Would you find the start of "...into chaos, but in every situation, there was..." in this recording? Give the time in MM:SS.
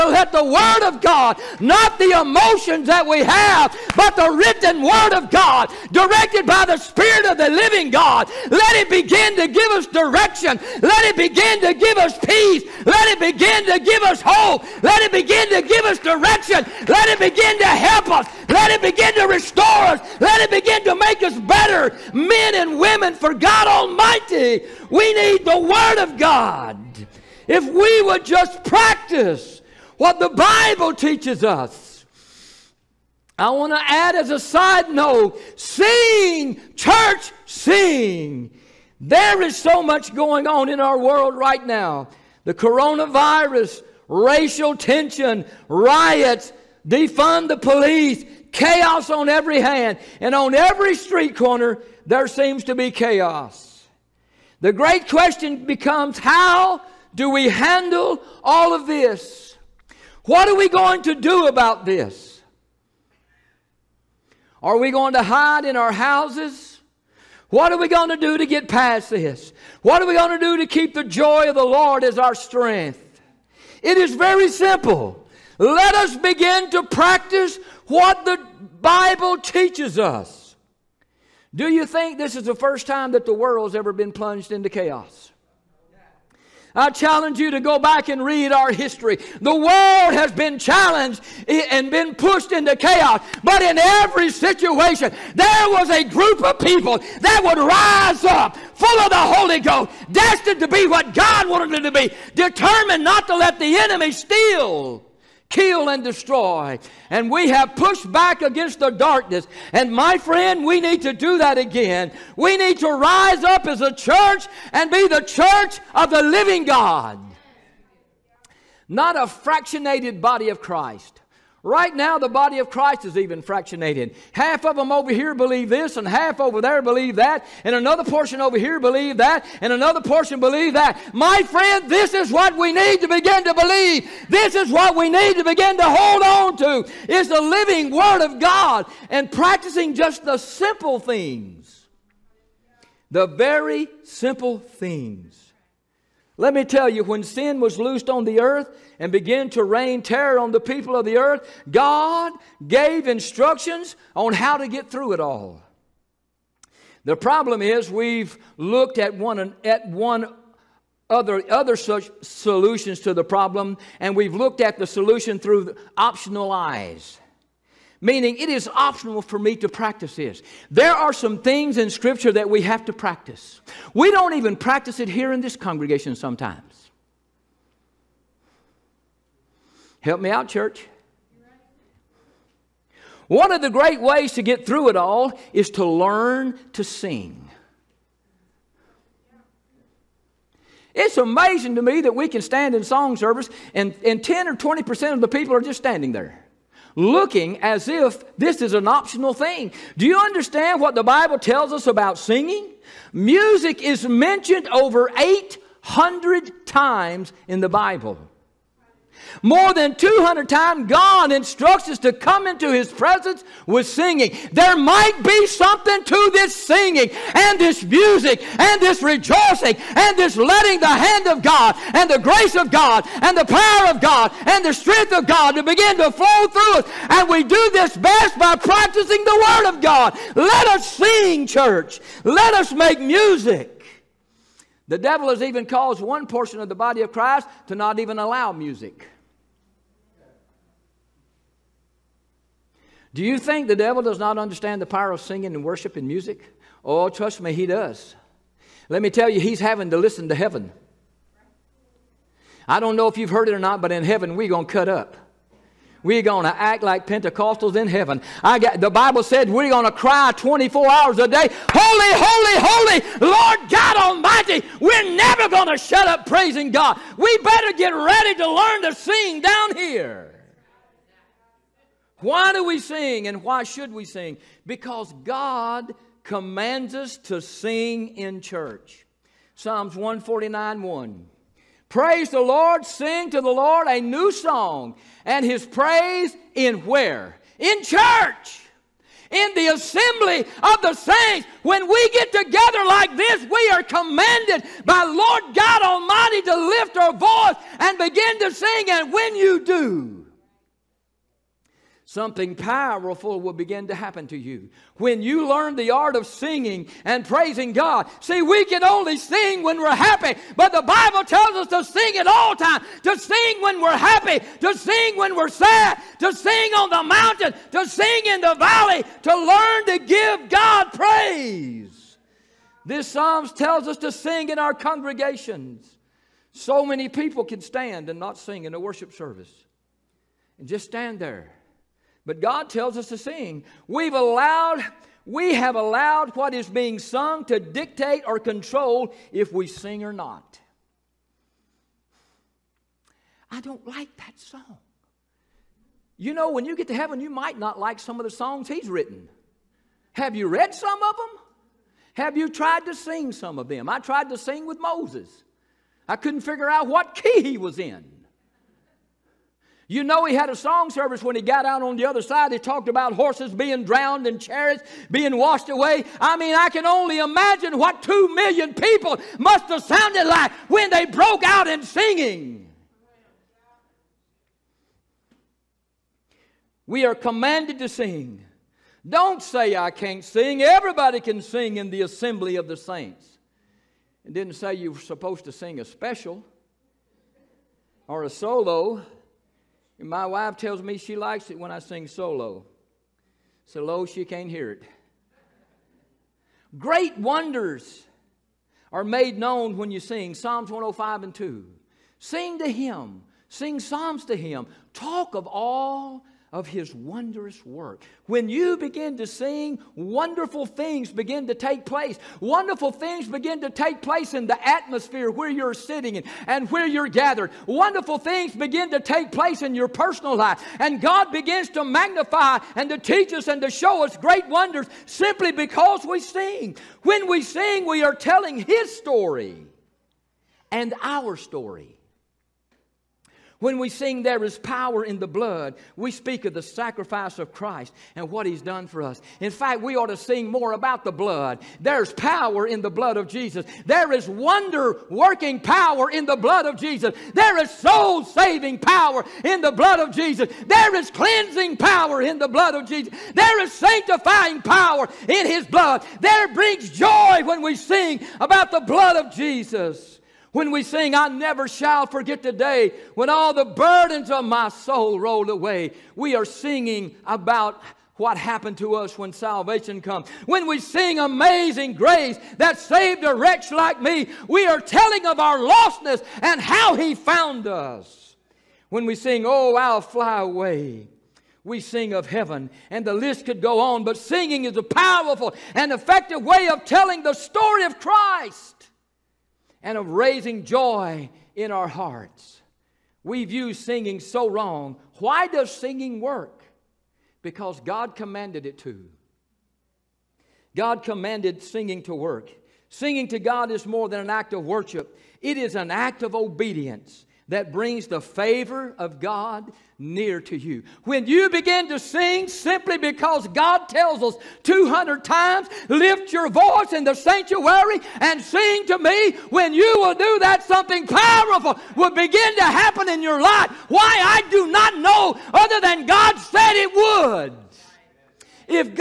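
01:32.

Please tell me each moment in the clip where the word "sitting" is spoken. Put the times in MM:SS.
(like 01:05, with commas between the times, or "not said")
06:55.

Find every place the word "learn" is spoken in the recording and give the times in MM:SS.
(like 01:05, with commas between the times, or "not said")
03:05, 04:28, 05:05, 05:19.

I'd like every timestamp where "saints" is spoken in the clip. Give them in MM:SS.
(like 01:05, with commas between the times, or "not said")
04:50, 06:22.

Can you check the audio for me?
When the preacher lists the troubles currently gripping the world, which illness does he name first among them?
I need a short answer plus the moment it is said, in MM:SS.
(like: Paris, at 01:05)
Coronavirus, at 00:42.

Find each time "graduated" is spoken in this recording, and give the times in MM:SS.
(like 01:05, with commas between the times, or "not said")
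not said.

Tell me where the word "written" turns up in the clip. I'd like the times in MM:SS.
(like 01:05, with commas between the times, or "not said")
00:04, 05:48.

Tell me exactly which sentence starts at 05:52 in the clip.
Have you tried to sing some of them?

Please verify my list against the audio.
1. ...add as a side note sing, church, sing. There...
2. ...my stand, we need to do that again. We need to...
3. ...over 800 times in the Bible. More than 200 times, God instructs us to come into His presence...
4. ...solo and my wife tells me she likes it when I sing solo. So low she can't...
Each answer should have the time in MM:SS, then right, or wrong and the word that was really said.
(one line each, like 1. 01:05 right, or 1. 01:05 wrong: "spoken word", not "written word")
1. 00:33 right
2. 01:49 wrong: "friend", not "stand"
3. 03:24 right
4. 06:28 right.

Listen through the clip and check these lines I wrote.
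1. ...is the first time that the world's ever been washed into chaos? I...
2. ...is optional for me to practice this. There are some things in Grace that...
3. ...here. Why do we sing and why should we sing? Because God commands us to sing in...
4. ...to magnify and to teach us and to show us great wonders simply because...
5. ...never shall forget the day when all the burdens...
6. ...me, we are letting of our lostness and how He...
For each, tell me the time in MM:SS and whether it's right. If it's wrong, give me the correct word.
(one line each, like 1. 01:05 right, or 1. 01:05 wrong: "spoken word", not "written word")
1. 01:22 wrong: "plunged", not "washed"
2. 02:48 wrong: "Scripture", not "Grace"
3. 04:29 right
4. 07:01 right
5. 07:41 right
6. 07:53 wrong: "telling", not "letting".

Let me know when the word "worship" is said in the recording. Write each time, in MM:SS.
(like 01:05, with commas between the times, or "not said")
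04:05, 05:28, 08:24.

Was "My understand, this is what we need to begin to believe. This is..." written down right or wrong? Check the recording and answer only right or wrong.
wrong.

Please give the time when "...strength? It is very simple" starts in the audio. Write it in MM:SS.
01:12.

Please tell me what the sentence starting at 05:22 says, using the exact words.
This Psalms tells us to sing in our congregations.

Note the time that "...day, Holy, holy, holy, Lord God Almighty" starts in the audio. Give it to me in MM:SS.
04:21.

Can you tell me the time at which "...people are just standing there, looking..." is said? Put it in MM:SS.
03:15.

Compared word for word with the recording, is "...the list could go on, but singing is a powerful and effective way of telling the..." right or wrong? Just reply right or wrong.
right.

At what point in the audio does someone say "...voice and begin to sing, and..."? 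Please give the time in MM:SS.
04:57.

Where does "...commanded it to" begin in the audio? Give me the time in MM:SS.
08:18.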